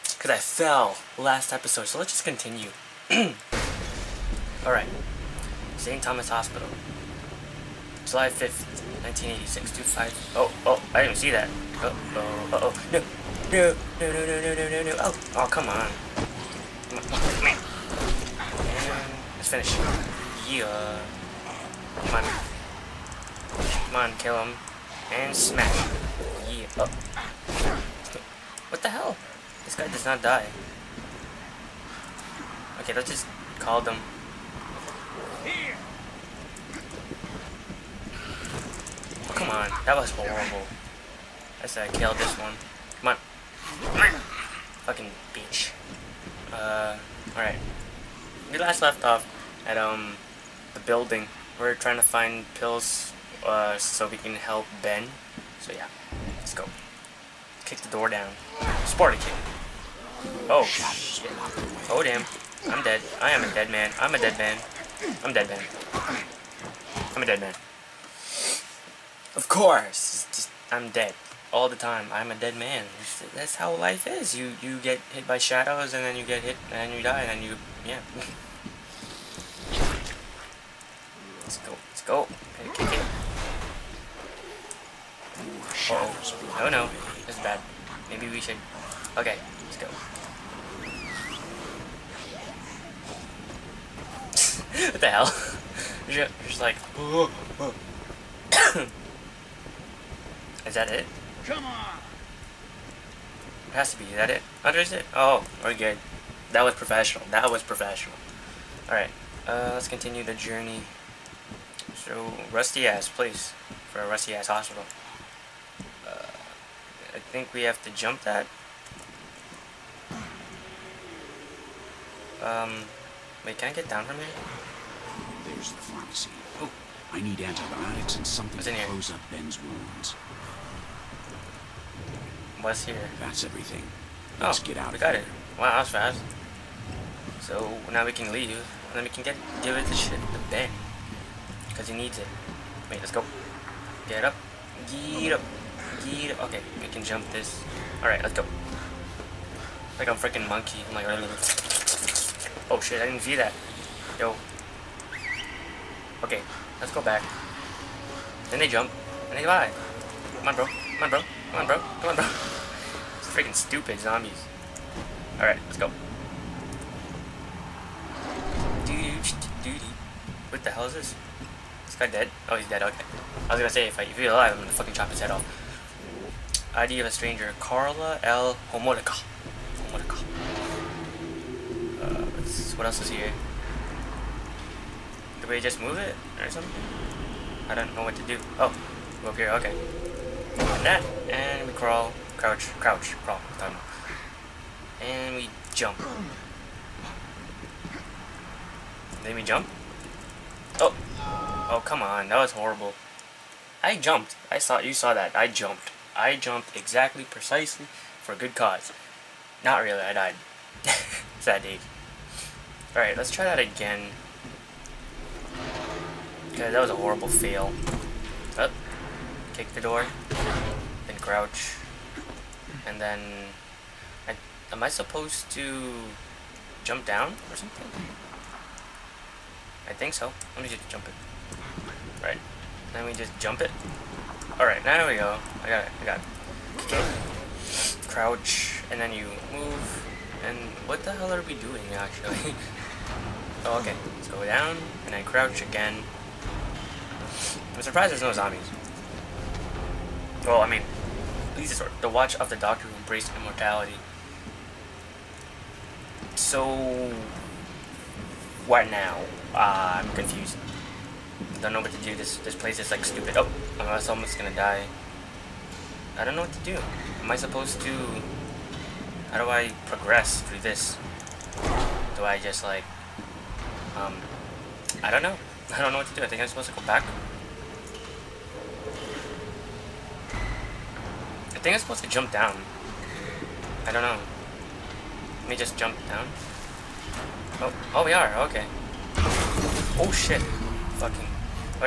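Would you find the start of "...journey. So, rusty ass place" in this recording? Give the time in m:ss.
1:50.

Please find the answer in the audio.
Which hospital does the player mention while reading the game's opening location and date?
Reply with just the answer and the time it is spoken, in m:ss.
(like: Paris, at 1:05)
St. Thomas Hospital, at 0:05.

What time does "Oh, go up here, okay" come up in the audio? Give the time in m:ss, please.
3:08.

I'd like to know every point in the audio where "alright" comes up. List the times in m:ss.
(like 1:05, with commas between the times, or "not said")
0:04, 0:47, 1:48, 2:45, 3:54.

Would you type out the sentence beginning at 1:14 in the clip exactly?
You you get hit by shadows, and then you get hit, and you die, and then you yeah.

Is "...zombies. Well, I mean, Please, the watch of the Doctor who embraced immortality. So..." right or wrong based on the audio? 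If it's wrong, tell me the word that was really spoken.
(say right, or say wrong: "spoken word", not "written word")
right.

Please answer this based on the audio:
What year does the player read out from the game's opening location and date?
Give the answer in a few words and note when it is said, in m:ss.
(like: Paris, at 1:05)
1986, at 0:09.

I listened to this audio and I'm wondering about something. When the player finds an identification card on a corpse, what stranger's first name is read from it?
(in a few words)
Carla.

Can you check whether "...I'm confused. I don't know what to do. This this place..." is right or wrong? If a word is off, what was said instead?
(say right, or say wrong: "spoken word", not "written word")
right.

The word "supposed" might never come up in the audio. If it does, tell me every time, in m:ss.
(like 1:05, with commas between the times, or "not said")
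3:44, 4:27, 4:36, 4:41.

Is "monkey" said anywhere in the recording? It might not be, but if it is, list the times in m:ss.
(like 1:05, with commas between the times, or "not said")
2:30.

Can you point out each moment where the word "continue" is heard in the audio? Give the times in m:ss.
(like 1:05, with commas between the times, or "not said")
0:02, 1:49.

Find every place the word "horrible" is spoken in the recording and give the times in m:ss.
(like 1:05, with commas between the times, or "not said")
0:40, 3:22, 3:36.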